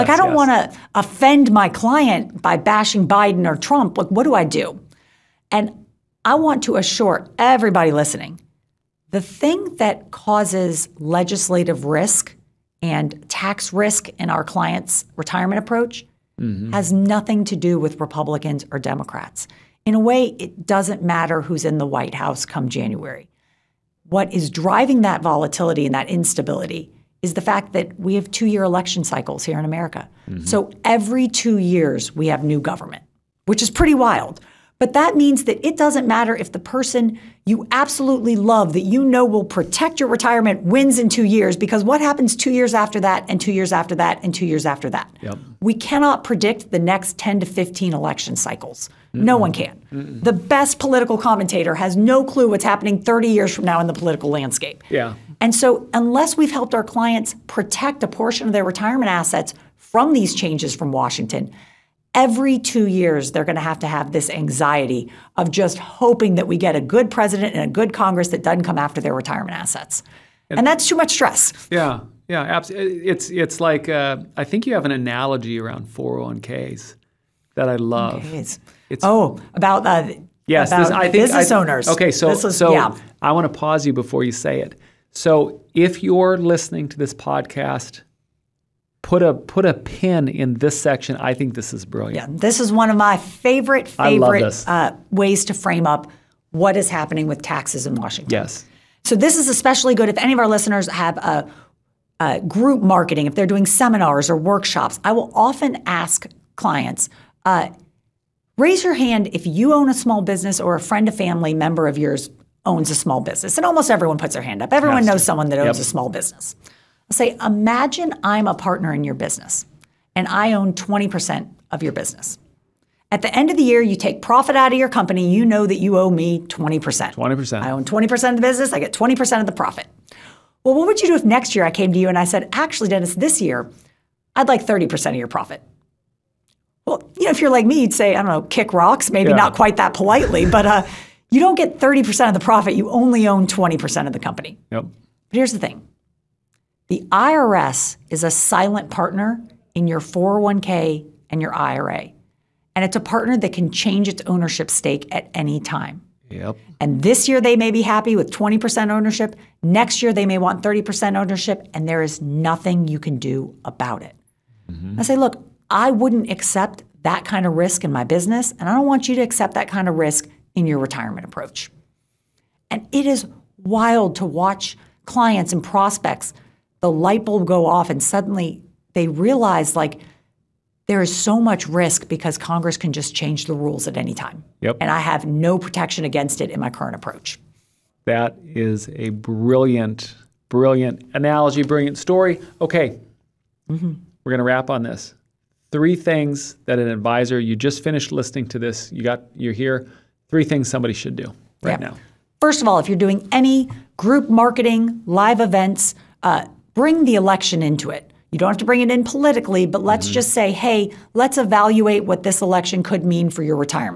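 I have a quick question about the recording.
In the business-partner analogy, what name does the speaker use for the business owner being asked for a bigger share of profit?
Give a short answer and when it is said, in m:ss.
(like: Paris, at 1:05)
Dennis, at 2:12.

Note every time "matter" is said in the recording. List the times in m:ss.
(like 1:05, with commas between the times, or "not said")
0:21, 0:36.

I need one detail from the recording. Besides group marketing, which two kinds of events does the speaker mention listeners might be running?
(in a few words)
seminars or workshops.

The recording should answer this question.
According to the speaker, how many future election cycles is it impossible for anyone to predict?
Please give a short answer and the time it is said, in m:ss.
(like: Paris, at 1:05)
10 to 15, at 0:47.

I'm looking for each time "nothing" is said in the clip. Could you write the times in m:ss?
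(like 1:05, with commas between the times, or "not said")
0:16, 2:42.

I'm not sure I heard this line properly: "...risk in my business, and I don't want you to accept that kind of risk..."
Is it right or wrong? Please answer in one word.
right.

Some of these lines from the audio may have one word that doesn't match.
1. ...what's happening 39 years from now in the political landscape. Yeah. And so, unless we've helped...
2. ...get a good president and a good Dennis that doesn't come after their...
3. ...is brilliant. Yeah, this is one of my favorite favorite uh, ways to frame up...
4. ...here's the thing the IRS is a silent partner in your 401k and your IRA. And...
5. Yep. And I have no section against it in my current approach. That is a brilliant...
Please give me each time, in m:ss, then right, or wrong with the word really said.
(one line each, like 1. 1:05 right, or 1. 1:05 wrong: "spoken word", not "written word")
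1. 0:52 wrong: "30", not "39"
2. 1:06 wrong: "Congress", not "Dennis"
3. 1:31 right
4. 2:25 right
5. 3:04 wrong: "protection", not "section".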